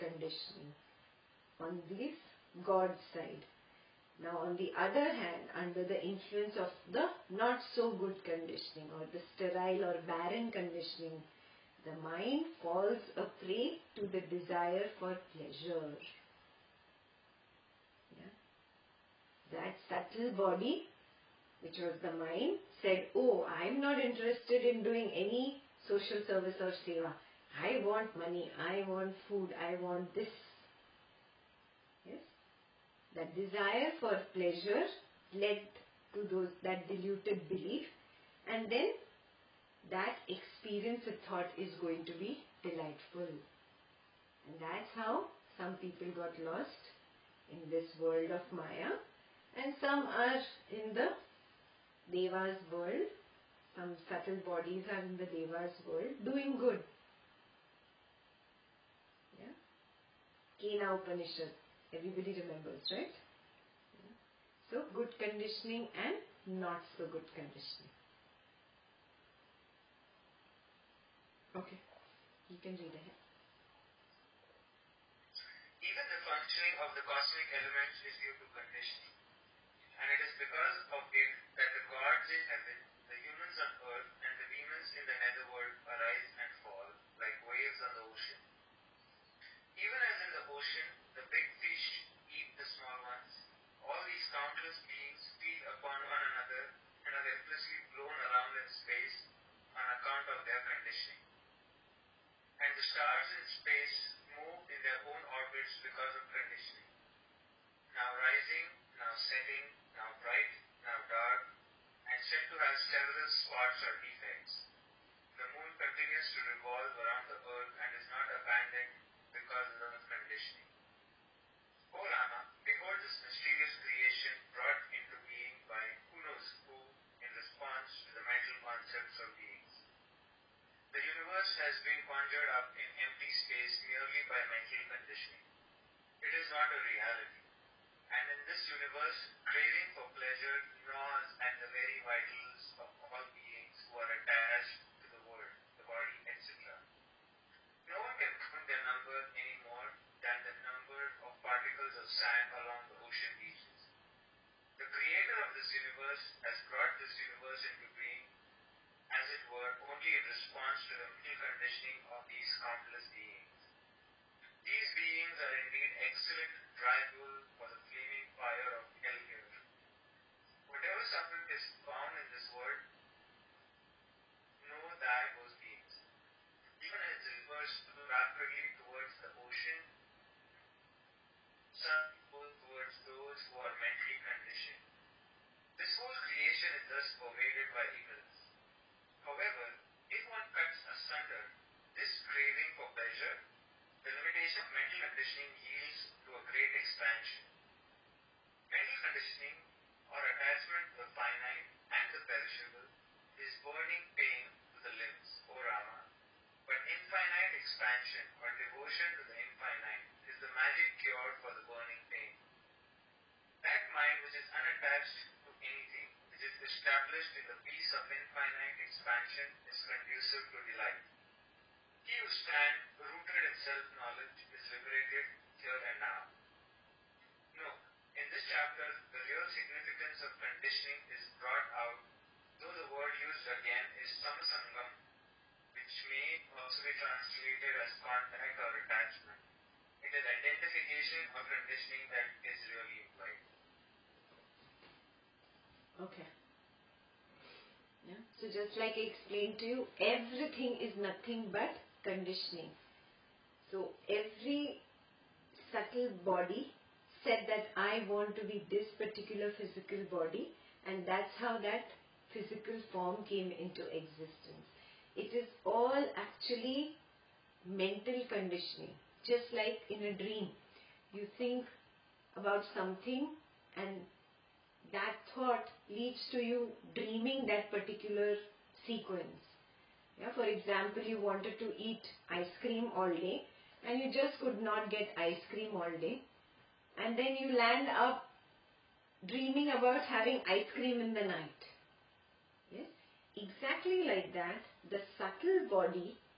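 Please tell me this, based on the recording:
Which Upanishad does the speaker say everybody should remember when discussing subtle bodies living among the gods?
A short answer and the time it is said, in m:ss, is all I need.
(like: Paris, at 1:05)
Kena Upanishad, at 1:00.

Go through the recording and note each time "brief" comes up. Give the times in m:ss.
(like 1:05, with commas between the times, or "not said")
not said.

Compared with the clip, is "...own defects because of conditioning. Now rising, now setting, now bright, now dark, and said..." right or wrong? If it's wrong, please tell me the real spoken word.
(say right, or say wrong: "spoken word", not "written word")
wrong: "orbits", not "defects".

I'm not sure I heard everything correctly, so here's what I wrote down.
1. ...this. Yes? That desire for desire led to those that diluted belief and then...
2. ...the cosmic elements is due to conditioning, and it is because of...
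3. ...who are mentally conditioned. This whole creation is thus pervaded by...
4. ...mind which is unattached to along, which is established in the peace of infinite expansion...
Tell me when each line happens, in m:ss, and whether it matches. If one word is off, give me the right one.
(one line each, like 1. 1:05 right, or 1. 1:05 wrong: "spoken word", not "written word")
1. 0:30 wrong: "pleasure", not "desire"
2. 1:16 right
3. 3:03 right
4. 3:33 wrong: "anything", not "along".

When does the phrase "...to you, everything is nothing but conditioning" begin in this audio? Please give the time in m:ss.
4:09.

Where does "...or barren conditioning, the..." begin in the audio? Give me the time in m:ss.
0:09.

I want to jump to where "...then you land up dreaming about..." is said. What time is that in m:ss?
4:47.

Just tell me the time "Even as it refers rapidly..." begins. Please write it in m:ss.
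2:56.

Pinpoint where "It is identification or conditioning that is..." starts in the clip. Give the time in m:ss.
4:00.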